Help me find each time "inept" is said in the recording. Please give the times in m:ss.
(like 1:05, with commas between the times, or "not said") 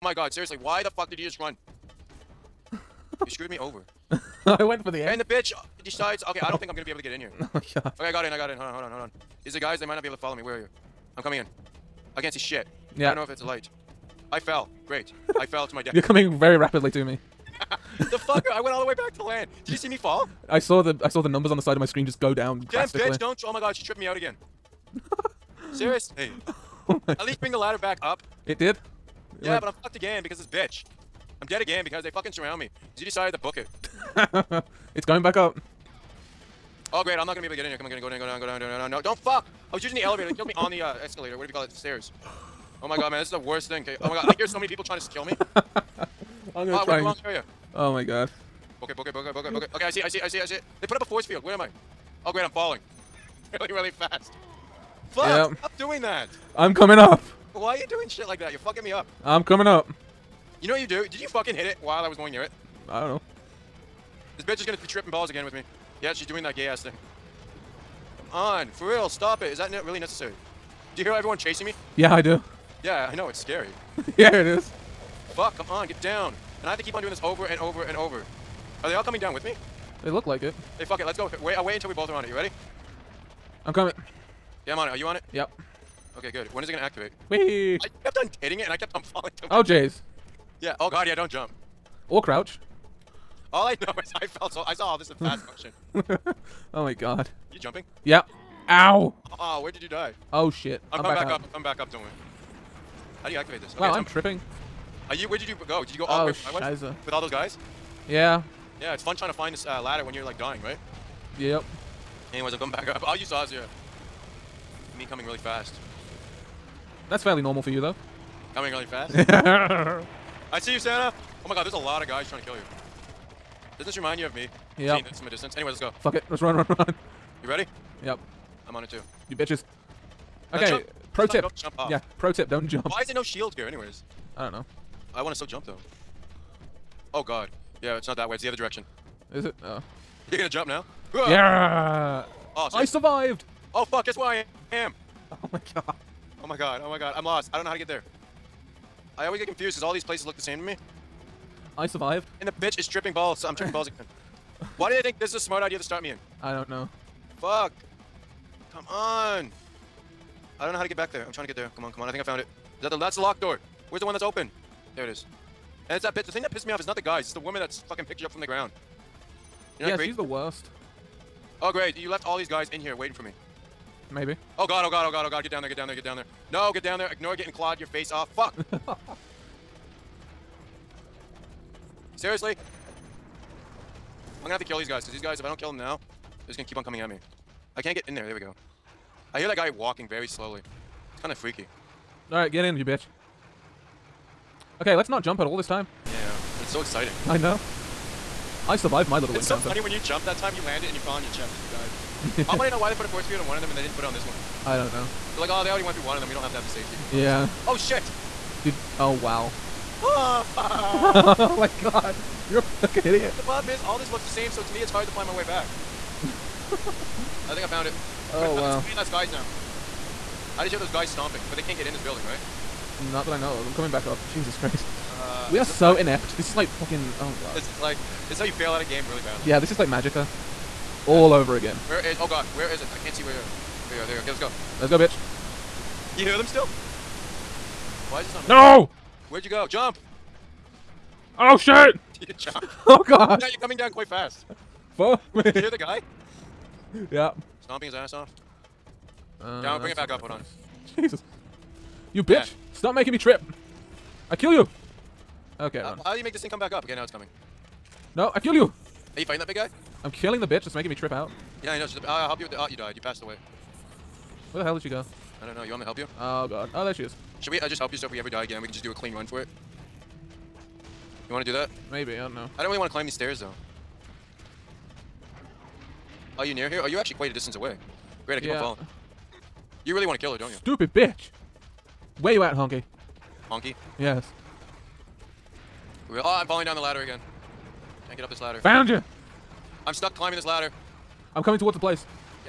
3:45.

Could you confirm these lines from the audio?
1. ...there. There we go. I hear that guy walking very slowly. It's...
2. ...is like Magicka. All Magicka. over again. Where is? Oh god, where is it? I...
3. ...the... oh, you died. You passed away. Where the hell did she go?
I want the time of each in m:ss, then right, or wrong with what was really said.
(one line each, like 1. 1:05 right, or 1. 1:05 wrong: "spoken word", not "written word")
1. 3:08 right
2. 3:49 right
3. 4:22 right.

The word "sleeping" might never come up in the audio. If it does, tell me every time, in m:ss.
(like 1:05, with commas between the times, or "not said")
not said.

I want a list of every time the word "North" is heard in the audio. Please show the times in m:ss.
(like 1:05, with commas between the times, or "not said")
not said.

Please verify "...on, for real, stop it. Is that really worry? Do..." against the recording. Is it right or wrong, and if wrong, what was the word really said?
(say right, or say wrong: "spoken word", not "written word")
wrong: "necessary", not "worry".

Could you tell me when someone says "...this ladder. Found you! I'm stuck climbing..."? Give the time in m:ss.
4:48.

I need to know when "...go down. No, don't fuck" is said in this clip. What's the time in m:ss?
0:38.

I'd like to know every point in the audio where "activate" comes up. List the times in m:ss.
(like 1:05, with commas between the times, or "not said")
1:26, 1:43.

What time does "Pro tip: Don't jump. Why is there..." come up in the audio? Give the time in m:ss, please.
2:12.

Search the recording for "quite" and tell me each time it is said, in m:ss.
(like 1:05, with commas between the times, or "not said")
4:03, 4:37.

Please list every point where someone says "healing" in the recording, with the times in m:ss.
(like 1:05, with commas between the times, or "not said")
not said.